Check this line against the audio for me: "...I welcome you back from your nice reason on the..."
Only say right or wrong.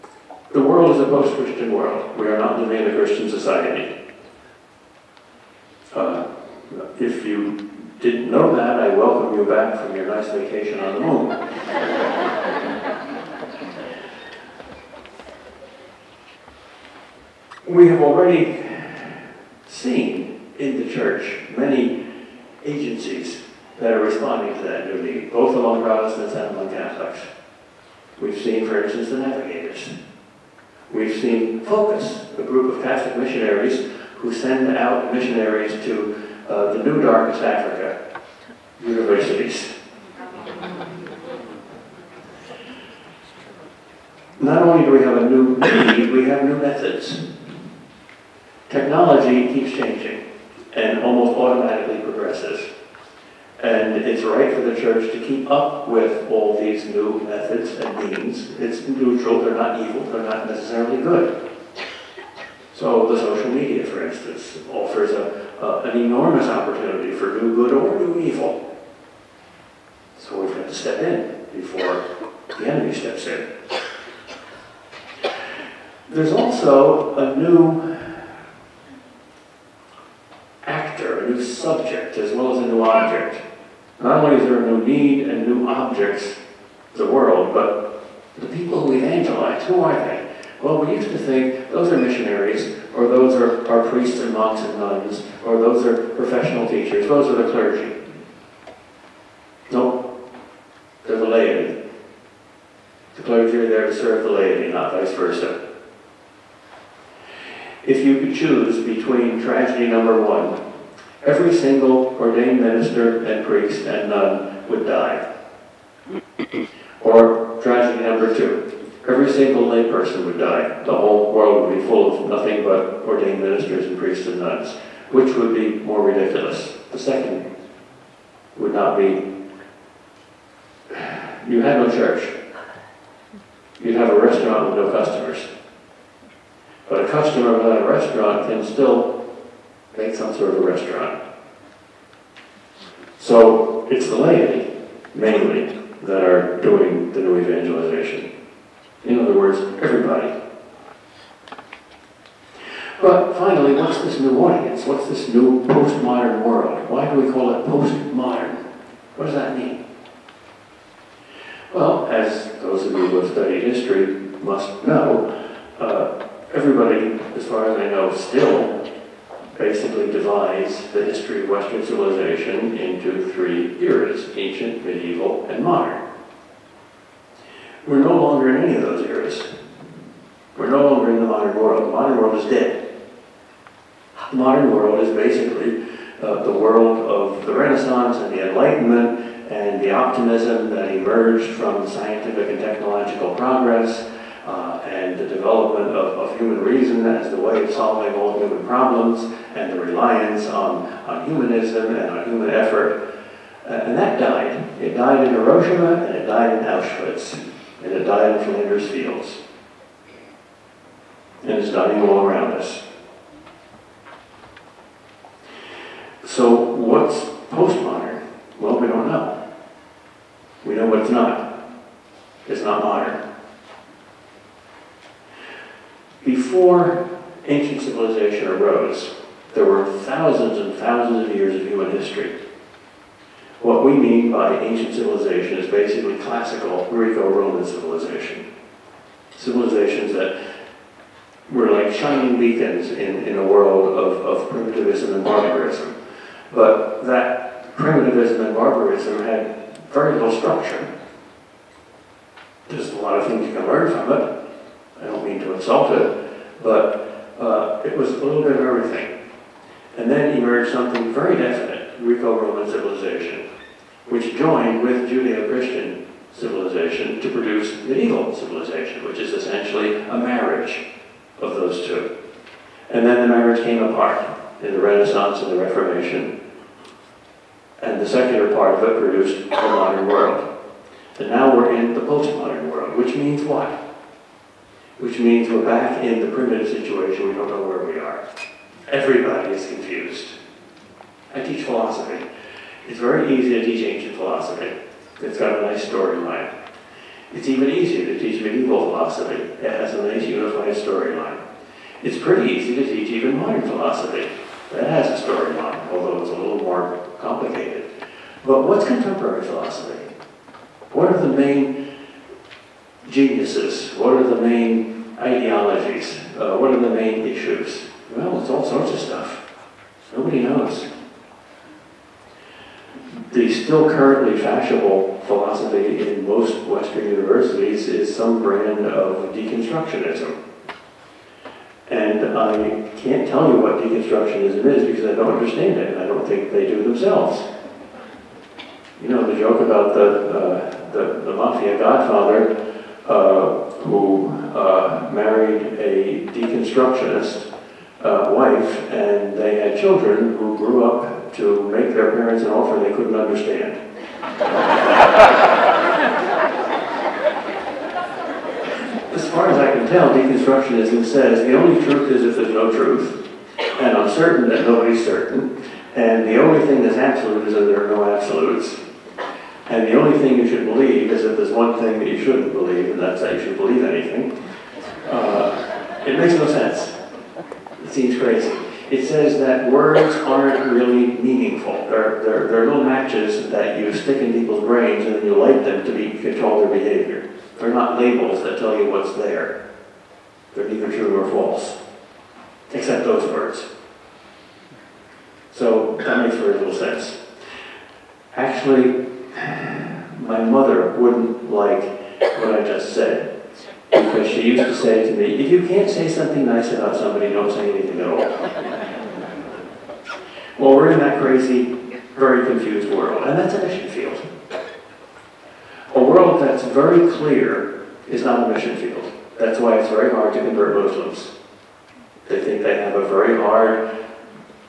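wrong.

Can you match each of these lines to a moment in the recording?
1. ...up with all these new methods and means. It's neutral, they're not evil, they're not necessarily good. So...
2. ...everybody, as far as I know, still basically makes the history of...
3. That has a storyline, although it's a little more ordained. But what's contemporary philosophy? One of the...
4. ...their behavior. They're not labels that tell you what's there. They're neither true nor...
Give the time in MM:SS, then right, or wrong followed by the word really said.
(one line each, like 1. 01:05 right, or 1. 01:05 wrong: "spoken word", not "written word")
1. 00:55 right
2. 02:46 wrong: "divides", not "makes"
3. 05:04 wrong: "complicated", not "ordained"
4. 06:26 right.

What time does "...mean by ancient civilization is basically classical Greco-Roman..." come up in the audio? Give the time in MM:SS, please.
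03:53.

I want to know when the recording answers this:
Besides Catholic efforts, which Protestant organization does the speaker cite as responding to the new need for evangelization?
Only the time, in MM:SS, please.
00:29.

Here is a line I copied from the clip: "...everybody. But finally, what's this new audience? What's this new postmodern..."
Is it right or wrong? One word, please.
right.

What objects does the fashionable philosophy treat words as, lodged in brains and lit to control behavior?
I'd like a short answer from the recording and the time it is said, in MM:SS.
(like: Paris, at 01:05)
matches, at 06:22.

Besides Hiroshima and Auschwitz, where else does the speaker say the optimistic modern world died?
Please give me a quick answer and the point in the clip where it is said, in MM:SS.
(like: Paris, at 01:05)
Flanders Fields, at 03:28.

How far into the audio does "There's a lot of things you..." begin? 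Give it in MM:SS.
04:12.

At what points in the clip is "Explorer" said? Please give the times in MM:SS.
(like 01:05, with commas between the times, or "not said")
not said.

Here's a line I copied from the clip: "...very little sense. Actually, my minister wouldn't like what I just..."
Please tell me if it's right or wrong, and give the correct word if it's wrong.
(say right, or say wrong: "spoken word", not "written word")
wrong: "mother", not "minister".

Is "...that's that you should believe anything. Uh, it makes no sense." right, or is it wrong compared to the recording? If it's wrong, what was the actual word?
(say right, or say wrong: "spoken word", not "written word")
right.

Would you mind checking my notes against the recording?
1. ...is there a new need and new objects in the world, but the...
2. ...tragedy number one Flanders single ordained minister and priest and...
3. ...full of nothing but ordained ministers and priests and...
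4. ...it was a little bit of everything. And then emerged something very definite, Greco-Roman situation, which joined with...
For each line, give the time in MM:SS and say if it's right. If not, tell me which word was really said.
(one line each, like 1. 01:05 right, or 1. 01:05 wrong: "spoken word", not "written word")
1. 01:24 right
2. 01:49 wrong: "Every", not "Flanders"
3. 02:01 right
4. 04:17 wrong: "civilization", not "situation".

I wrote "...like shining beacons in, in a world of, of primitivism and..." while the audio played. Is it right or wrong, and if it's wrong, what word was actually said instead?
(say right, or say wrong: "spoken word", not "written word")
right.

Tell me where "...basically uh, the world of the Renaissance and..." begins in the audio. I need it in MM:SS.
03:05.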